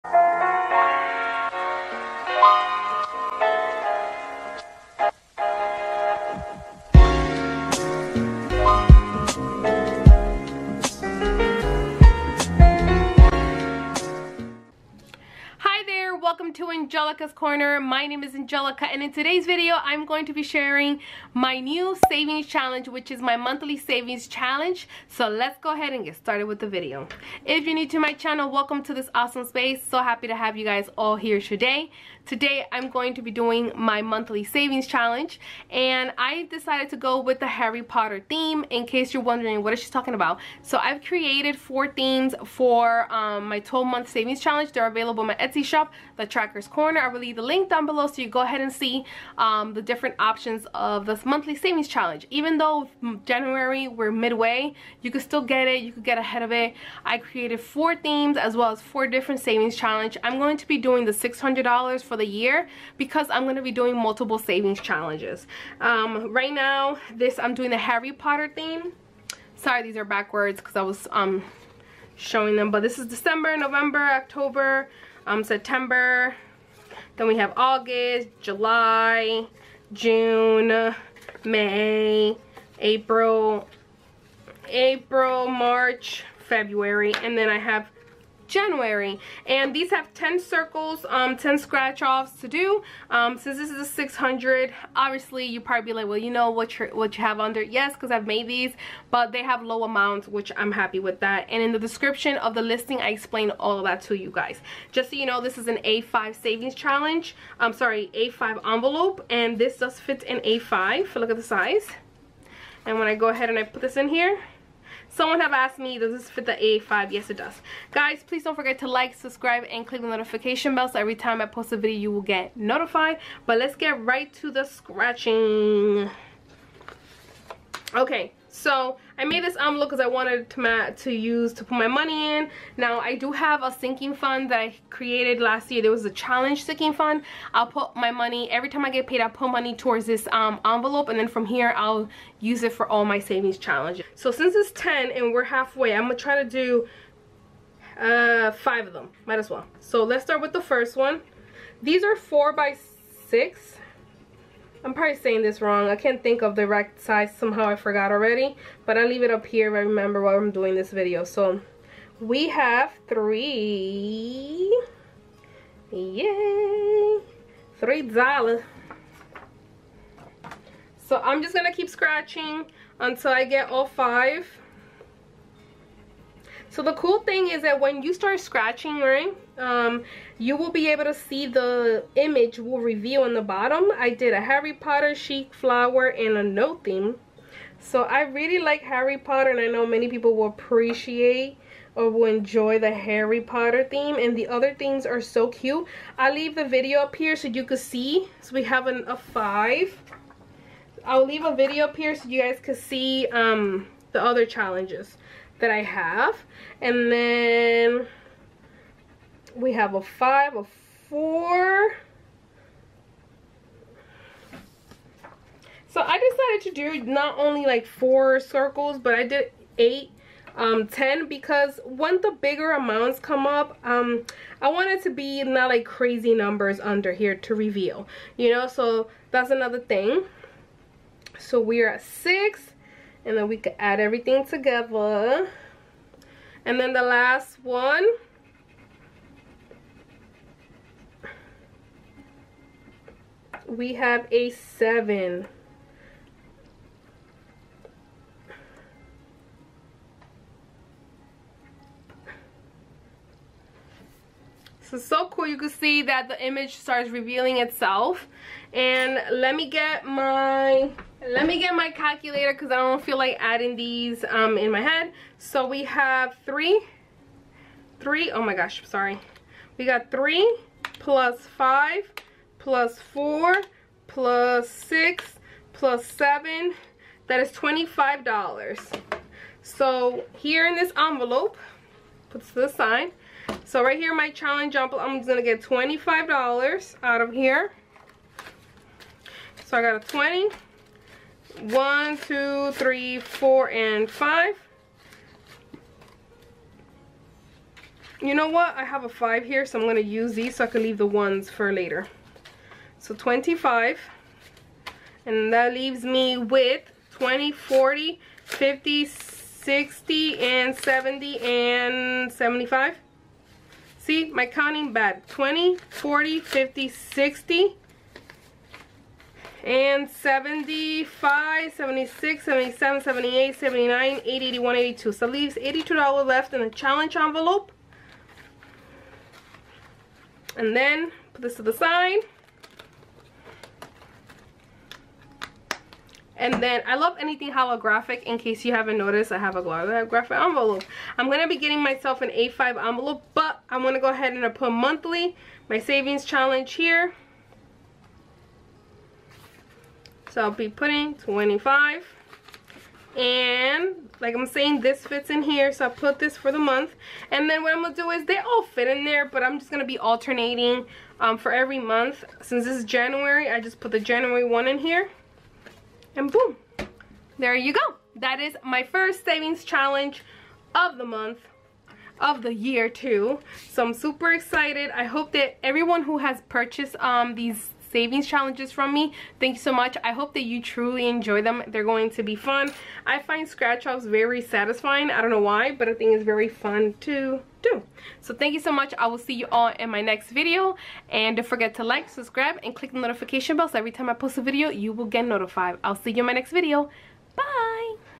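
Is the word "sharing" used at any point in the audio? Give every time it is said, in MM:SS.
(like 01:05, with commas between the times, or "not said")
00:20.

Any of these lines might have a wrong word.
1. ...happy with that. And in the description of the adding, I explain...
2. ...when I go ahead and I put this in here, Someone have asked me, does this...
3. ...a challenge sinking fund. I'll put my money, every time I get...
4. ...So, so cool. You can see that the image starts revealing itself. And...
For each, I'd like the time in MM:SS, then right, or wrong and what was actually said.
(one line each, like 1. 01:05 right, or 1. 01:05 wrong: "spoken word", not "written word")
1. 01:40 wrong: "listing", not "adding"
2. 01:52 right
3. 02:16 right
4. 04:14 right.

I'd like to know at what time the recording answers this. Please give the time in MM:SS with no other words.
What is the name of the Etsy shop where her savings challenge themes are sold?
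00:46.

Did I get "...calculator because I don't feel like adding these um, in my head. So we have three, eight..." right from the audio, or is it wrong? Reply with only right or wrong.
wrong.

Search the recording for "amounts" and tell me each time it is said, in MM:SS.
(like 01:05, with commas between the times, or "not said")
01:39, 03:42.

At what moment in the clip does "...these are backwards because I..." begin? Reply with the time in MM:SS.
01:09.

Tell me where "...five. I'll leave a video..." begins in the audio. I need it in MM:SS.
03:19.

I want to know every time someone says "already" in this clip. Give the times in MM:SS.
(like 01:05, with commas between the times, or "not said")
02:38.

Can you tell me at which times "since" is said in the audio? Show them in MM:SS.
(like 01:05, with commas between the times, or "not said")
01:33, 02:24, 06:02.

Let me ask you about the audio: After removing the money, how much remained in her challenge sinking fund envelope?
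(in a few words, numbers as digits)
$82.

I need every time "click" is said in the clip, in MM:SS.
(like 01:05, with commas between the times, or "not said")
01:59, 06:32.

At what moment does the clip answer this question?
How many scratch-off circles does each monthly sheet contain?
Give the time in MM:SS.
01:30.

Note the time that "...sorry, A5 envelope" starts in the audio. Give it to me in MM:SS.
01:47.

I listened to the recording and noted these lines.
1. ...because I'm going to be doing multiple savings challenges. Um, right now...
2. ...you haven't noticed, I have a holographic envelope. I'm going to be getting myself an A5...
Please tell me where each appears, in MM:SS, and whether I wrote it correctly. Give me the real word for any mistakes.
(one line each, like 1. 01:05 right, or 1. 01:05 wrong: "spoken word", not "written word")
1. 01:02 right
2. 05:38 right.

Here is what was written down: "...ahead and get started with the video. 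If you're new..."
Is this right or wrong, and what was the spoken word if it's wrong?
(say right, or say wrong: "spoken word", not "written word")
right.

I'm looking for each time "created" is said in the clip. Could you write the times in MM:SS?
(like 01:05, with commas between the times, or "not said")
00:41, 00:57, 02:14.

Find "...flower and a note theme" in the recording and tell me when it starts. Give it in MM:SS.
03:05.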